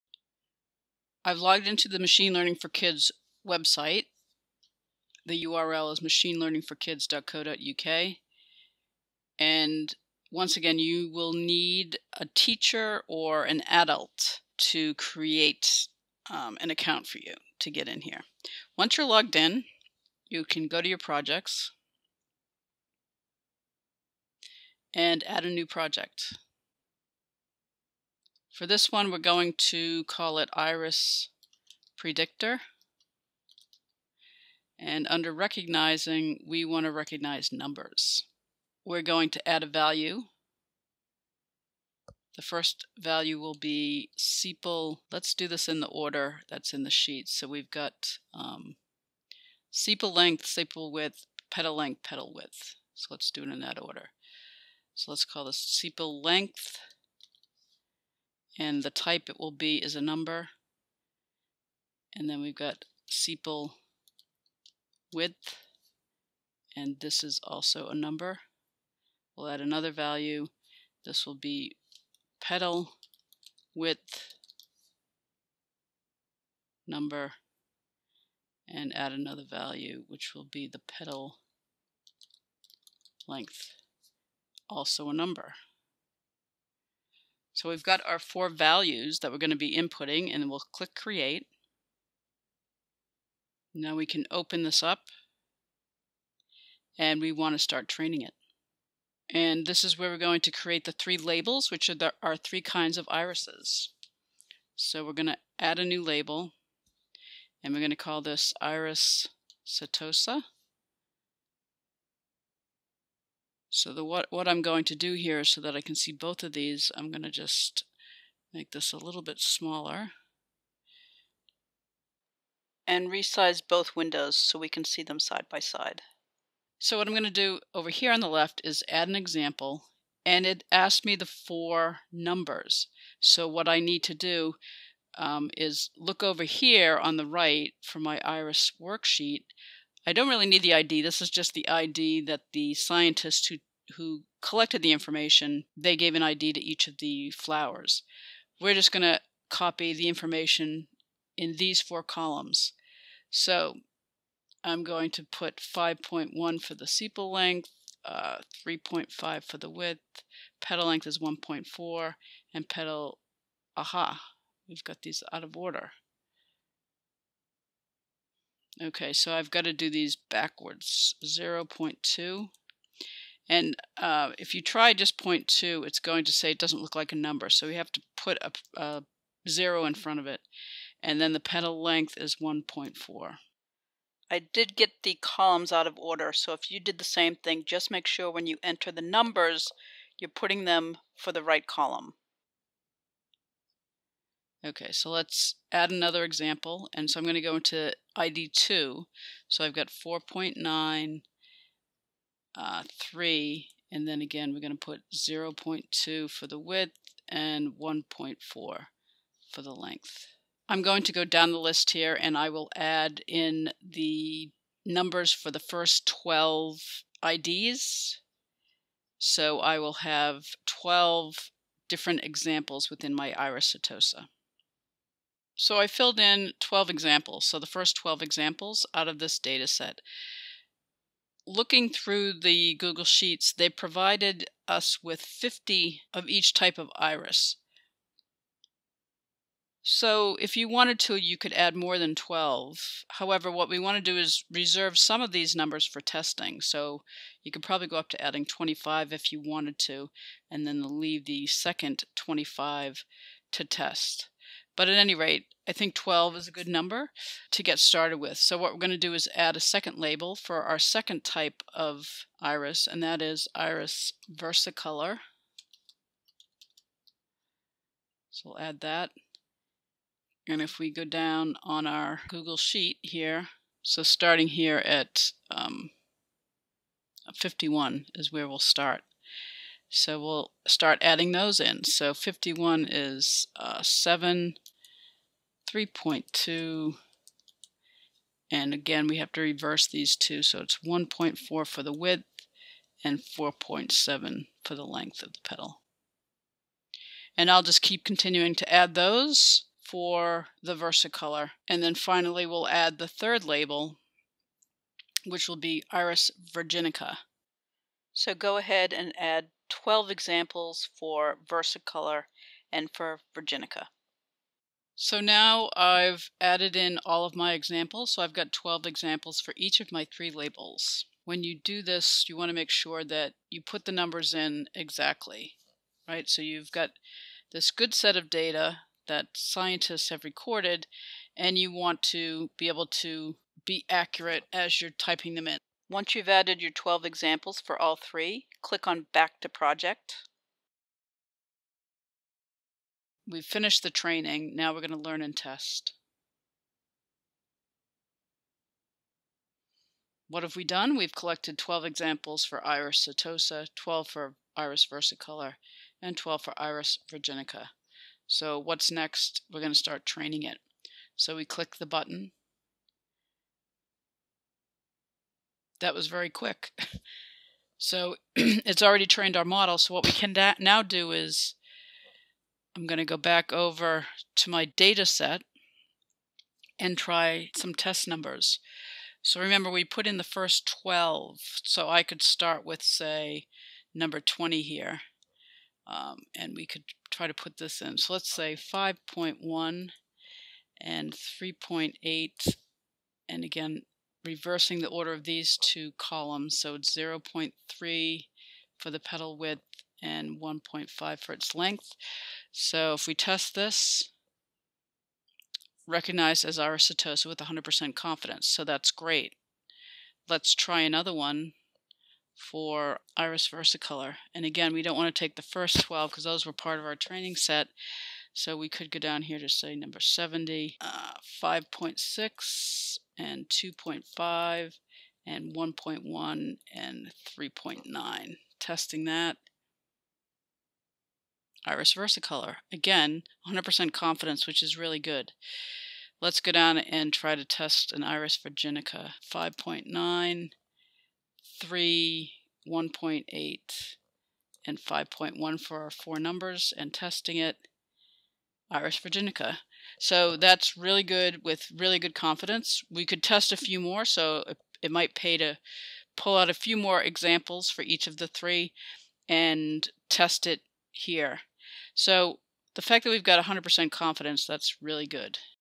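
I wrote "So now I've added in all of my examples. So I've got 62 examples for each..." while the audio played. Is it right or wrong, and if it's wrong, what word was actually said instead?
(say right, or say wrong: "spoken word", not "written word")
wrong: "12", not "62".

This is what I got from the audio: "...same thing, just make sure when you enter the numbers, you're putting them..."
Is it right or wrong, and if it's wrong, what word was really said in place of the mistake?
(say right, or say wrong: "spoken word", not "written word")
right.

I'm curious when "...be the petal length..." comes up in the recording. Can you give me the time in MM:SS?
01:20.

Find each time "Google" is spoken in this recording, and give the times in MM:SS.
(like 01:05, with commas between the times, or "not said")
03:52, 04:32.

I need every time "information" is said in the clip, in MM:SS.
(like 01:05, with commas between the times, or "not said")
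02:24, 02:30.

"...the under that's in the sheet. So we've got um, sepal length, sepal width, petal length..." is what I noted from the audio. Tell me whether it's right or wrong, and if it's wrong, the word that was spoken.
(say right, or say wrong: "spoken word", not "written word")
wrong: "order", not "under".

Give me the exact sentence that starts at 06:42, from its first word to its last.
So if we test this, recognized as Iris setosa with 100% confidence.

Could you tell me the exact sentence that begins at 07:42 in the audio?
So the fact that we've got 100% confidence, that's really good.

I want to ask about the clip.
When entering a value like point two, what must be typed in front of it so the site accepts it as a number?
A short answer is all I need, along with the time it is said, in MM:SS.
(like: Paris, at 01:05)
A zero, at 02:58.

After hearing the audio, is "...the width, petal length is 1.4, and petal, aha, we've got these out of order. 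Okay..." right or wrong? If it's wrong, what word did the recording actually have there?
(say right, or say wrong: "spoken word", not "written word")
right.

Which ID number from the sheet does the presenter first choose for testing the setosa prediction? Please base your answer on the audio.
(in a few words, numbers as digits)
20.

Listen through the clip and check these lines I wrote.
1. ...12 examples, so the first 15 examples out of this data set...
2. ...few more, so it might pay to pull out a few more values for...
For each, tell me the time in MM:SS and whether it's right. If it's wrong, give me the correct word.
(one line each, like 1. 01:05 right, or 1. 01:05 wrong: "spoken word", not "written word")
1. 03:46 wrong: "12", not "15"
2. 07:33 wrong: "examples", not "values".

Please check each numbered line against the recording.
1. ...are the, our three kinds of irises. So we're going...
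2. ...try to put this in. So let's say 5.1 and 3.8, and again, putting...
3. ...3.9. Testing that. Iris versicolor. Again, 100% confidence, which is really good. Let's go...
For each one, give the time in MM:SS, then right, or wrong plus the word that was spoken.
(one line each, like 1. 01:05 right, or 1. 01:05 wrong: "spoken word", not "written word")
1. 01:41 right
2. 06:27 wrong: "reversing", not "putting"
3. 07:07 right.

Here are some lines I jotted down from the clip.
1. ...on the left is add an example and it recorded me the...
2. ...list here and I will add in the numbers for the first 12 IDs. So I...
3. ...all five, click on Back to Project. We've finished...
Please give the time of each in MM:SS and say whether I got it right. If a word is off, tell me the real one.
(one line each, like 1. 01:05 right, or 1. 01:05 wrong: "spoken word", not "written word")
1. 02:08 wrong: "asked", not "recorded"
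2. 03:31 right
3. 05:37 wrong: "three", not "five".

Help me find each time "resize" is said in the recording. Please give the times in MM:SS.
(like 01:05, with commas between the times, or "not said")
02:03.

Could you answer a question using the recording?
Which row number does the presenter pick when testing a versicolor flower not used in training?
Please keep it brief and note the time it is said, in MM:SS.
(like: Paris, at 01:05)
70, at 06:59.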